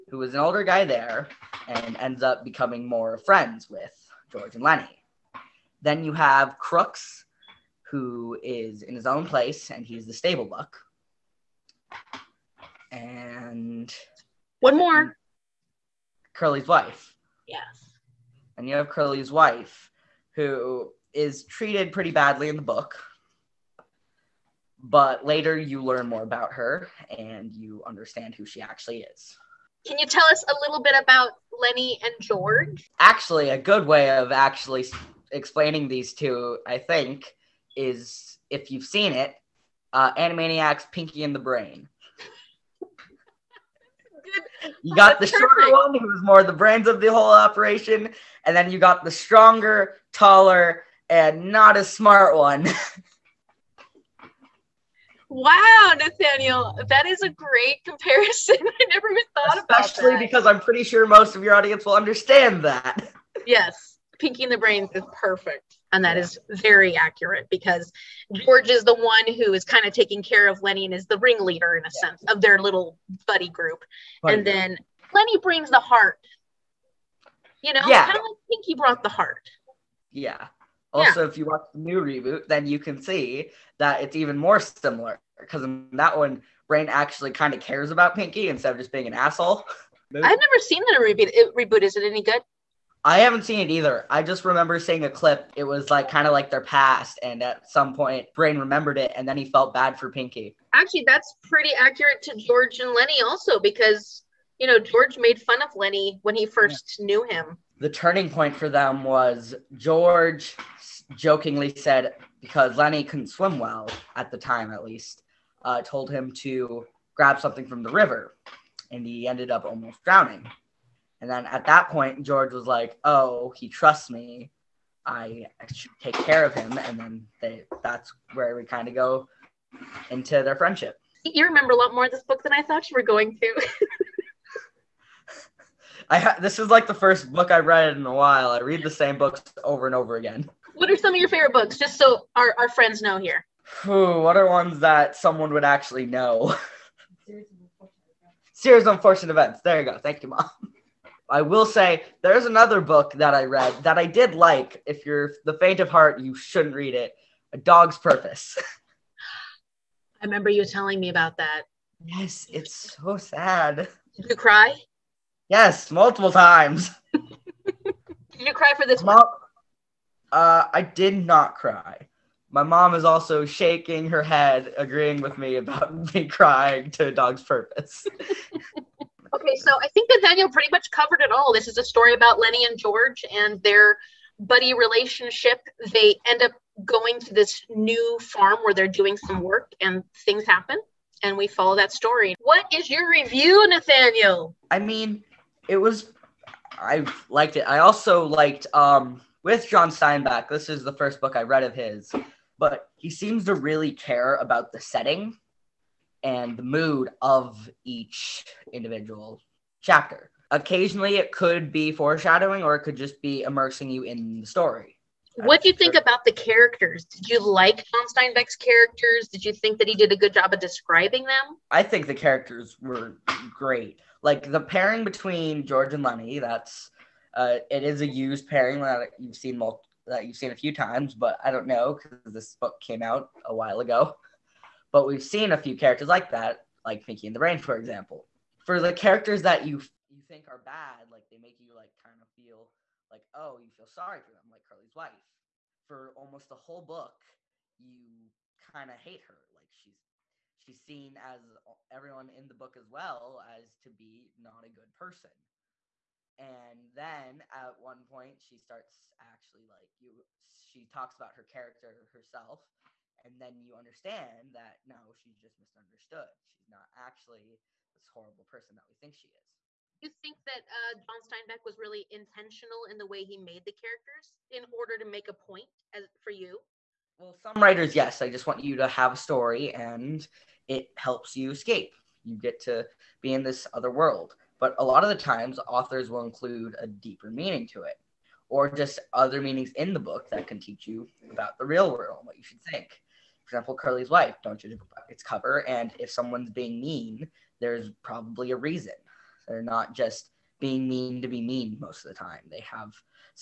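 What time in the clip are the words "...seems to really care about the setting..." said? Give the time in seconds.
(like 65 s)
203 s.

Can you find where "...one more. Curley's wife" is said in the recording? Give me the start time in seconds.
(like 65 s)
14 s.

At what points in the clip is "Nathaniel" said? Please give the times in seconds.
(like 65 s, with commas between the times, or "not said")
55 s, 193 s.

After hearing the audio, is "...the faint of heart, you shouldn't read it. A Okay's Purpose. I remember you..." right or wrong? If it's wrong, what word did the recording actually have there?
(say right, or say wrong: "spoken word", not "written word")
wrong: "Dog", not "Okay".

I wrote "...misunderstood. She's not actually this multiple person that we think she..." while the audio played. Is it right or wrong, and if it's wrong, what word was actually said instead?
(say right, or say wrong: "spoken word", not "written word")
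wrong: "horrible", not "multiple".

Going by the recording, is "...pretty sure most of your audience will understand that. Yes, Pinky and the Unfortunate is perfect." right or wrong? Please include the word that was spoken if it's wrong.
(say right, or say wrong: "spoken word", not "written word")
wrong: "Brains", not "Unfortunate".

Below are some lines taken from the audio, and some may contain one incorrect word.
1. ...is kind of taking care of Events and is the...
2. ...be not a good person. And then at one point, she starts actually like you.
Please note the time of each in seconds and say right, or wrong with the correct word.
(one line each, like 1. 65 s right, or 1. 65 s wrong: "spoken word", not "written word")
1. 69 s wrong: "Lennie", not "Events"
2. 253 s right.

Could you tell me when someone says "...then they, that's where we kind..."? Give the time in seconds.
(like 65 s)
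126 s.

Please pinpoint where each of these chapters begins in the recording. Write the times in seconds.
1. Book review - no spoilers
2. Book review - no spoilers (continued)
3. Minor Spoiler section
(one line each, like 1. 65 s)
1. 193 s
2. 270 s
3. 240 s.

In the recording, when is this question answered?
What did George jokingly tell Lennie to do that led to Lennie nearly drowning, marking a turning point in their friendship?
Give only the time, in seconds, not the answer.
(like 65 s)
117 s.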